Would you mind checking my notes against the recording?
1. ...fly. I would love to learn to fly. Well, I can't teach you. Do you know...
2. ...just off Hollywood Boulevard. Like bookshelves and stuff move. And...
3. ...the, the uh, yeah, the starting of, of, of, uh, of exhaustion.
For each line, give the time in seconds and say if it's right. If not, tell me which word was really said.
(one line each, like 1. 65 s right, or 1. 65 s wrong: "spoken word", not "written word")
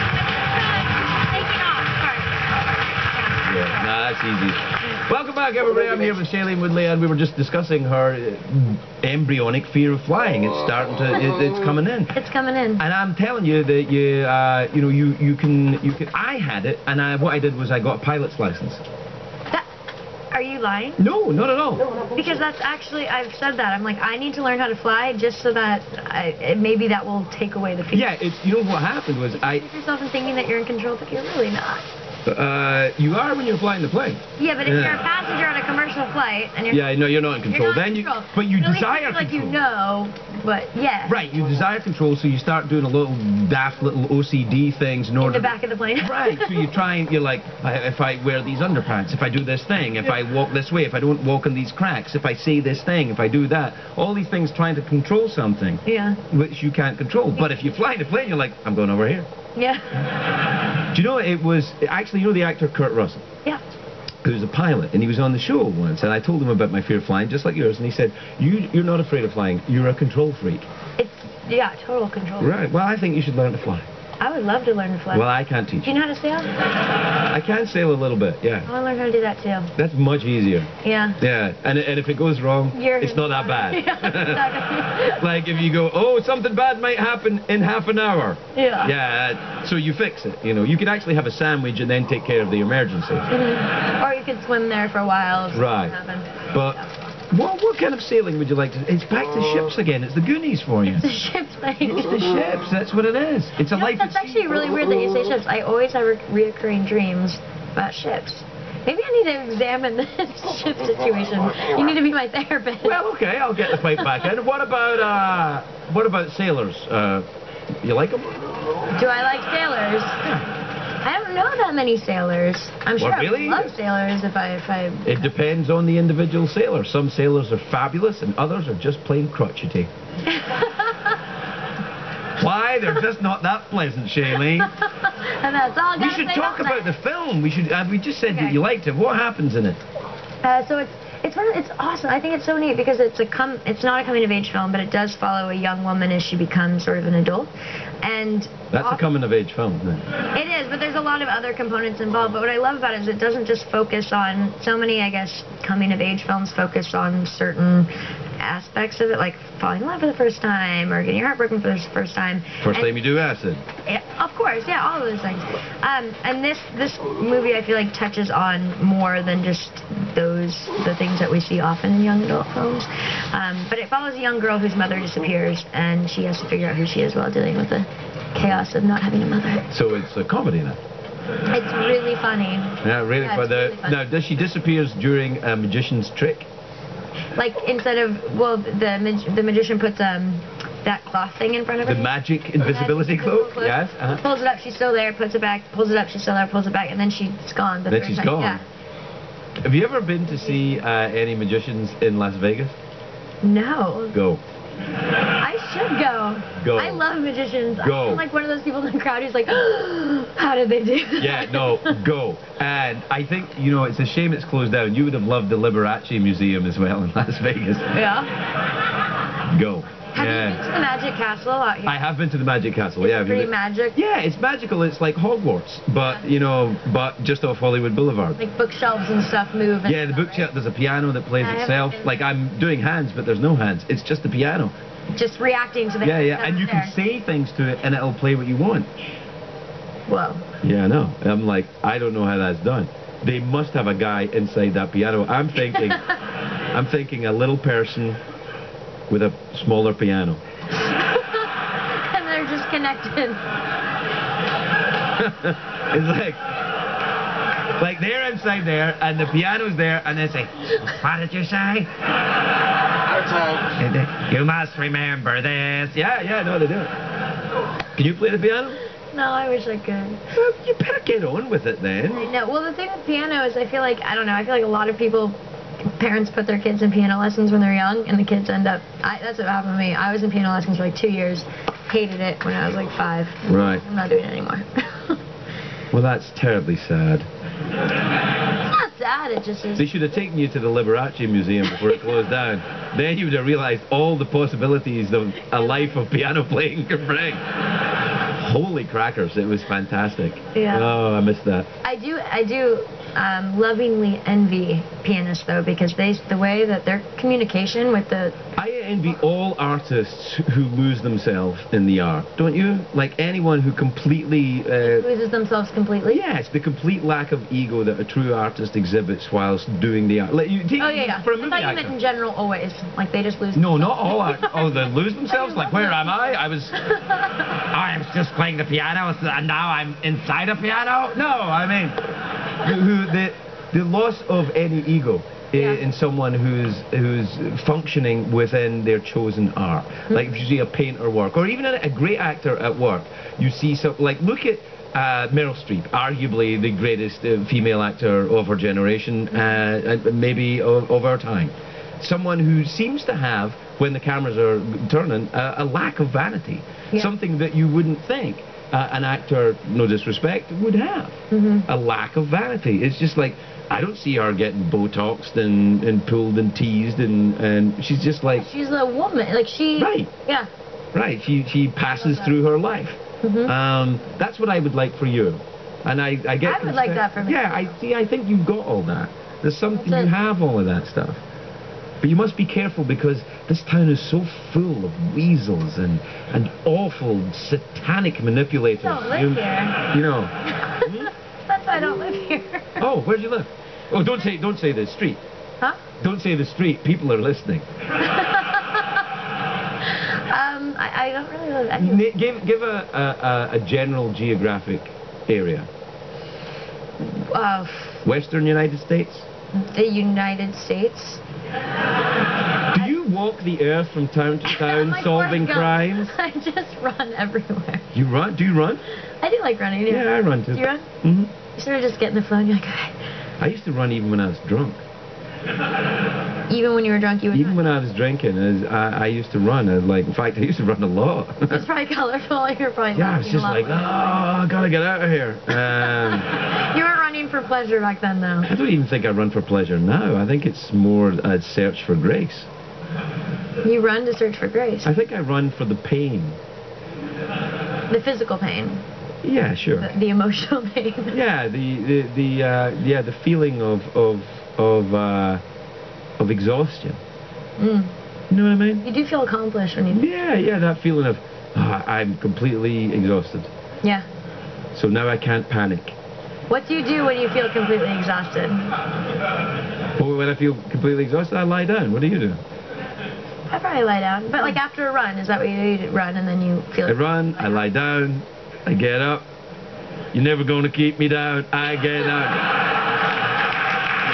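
1. 73 s right
2. 227 s right
3. 451 s wrong: "feeling", not "starting".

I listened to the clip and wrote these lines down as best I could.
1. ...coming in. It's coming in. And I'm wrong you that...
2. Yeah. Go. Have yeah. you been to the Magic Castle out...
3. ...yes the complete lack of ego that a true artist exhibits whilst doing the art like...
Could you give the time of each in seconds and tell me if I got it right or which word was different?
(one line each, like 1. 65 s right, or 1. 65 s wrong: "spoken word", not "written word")
1. 11 s wrong: "telling", not "wrong"
2. 217 s right
3. 316 s right.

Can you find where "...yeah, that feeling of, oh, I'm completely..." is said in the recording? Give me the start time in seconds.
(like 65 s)
460 s.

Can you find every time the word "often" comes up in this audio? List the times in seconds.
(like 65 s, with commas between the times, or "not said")
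148 s, 171 s.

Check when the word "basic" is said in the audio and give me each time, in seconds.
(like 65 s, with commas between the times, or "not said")
not said.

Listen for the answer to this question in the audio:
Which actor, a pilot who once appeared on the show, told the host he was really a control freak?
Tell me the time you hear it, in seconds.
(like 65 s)
62 s.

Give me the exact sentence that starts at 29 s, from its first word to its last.
You yourself in thinking that you're in control, but you're really not.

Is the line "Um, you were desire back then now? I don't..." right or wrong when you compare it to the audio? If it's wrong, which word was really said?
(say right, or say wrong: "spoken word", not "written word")
wrong: "pleasure", not "desire".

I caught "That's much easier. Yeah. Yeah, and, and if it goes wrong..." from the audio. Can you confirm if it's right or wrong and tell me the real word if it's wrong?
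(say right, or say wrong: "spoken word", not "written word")
right.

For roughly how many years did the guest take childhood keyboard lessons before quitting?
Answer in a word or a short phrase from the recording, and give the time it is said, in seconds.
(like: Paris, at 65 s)
2 years, at 280 s.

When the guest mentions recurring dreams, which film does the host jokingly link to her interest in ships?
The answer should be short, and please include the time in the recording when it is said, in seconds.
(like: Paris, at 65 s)
The Goonies, at 100 s.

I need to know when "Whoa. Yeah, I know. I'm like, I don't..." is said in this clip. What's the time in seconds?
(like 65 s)
240 s.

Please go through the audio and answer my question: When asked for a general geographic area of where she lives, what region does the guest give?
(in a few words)
Western United States.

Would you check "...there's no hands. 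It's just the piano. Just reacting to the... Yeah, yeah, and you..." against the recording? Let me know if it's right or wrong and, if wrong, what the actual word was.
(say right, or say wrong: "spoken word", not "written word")
right.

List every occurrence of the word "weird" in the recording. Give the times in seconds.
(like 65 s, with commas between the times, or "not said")
104 s.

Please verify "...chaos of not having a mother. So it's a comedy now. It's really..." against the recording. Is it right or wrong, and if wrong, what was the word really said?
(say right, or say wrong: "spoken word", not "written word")
right.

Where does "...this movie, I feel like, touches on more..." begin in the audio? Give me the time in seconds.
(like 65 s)
166 s.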